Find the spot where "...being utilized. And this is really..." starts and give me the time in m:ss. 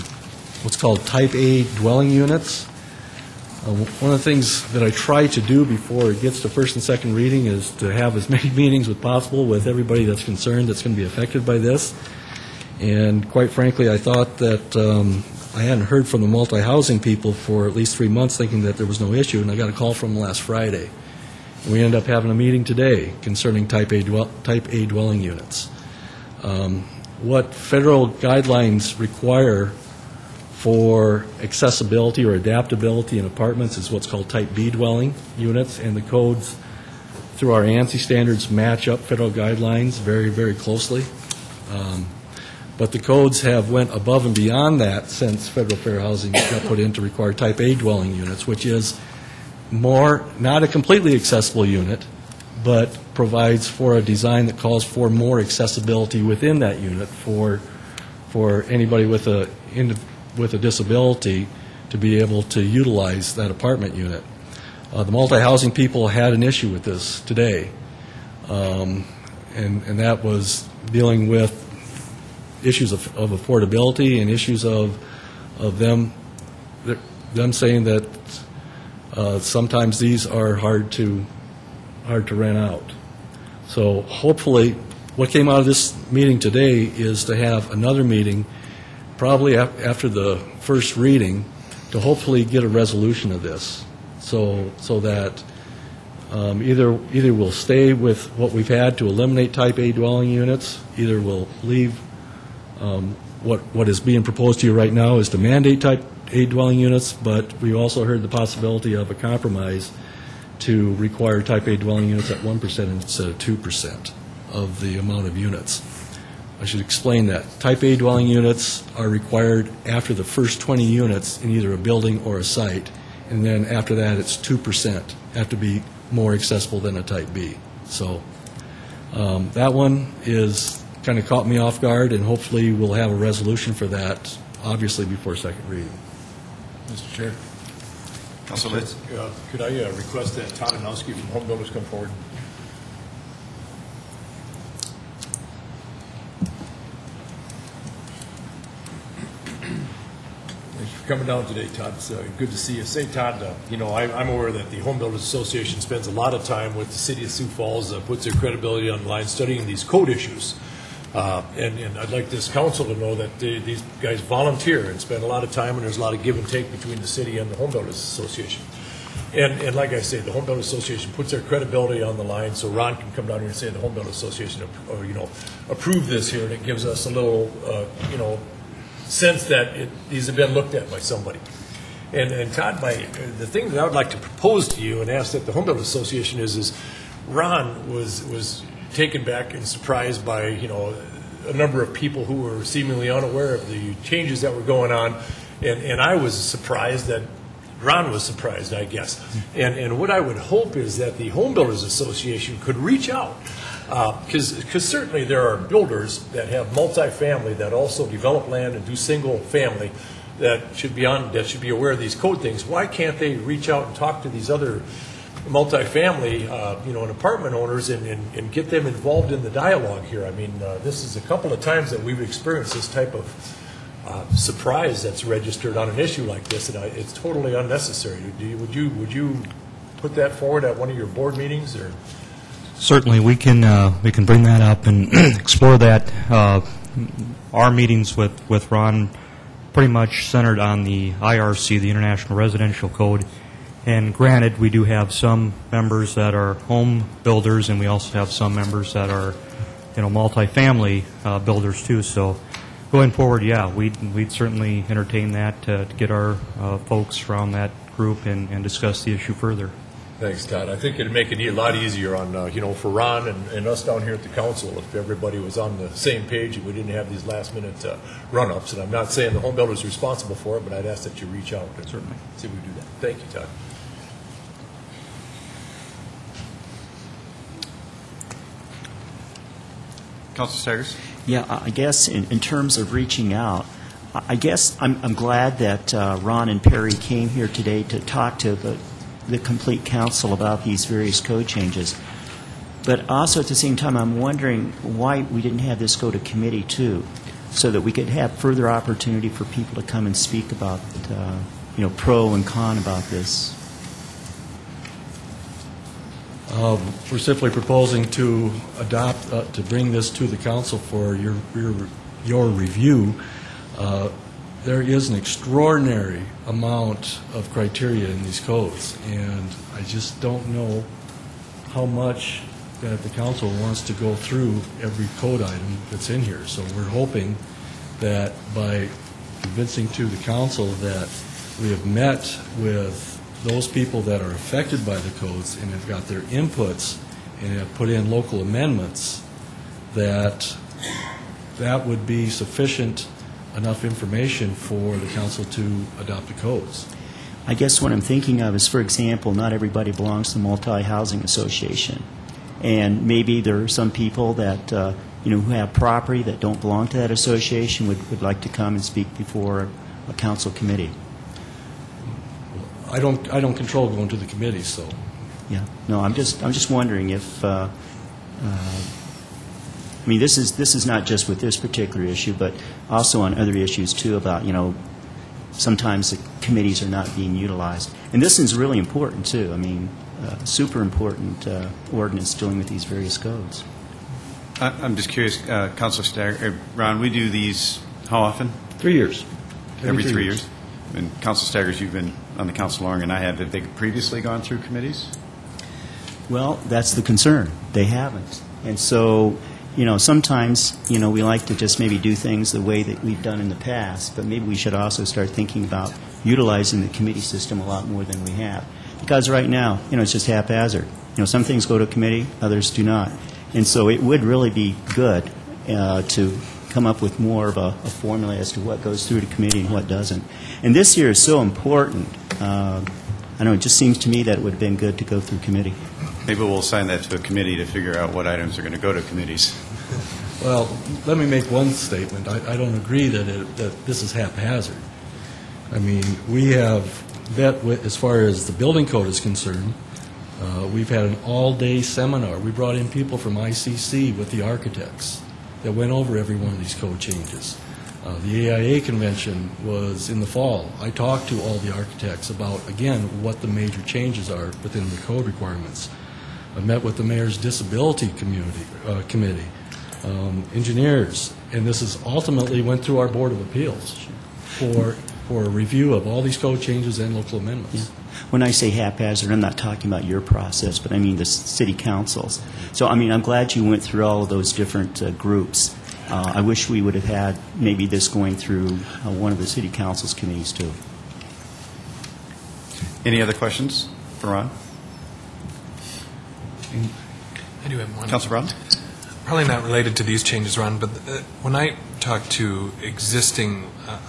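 6:17.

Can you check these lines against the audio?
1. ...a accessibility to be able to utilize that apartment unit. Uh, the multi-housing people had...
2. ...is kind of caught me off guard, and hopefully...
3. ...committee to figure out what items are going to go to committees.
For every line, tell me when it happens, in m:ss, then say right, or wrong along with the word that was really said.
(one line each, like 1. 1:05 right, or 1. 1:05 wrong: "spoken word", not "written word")
1. 1:00 wrong: "disability", not "accessibility"
2. 2:10 right
3. 7:07 right.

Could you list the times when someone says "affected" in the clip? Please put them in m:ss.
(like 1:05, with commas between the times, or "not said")
0:11, 5:34.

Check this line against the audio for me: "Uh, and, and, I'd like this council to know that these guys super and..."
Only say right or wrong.
wrong.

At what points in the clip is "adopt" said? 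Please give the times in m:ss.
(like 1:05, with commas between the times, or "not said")
5:08, 5:45.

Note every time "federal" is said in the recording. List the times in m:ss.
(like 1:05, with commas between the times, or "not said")
0:27, 0:38, 0:45.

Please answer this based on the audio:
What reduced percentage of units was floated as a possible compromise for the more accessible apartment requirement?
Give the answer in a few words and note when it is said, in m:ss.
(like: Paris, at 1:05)
1%, at 1:52.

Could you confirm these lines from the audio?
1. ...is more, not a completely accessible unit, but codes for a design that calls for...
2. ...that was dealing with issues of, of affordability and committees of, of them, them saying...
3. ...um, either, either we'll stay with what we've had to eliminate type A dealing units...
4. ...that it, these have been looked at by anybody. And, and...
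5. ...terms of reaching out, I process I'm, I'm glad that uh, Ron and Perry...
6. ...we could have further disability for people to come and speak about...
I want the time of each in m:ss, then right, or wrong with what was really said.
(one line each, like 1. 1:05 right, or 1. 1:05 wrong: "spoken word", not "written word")
1. 0:48 wrong: "provides", not "codes"
2. 1:09 wrong: "issues", not "committees"
3. 1:36 wrong: "dwelling", not "dealing"
4. 2:59 wrong: "somebody", not "anybody"
5. 4:42 wrong: "guess", not "process"
6. 4:57 wrong: "opportunity", not "disability".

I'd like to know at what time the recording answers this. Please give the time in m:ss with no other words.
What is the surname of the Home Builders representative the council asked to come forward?
2:20.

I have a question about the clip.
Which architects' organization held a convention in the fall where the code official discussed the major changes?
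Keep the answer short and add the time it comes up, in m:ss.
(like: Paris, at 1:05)
AIA, at 7:28.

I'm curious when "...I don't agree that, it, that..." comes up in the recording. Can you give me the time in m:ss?
7:12.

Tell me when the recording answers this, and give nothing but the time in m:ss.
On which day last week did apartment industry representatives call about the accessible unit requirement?
0:20.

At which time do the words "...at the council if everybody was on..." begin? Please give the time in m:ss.
4:24.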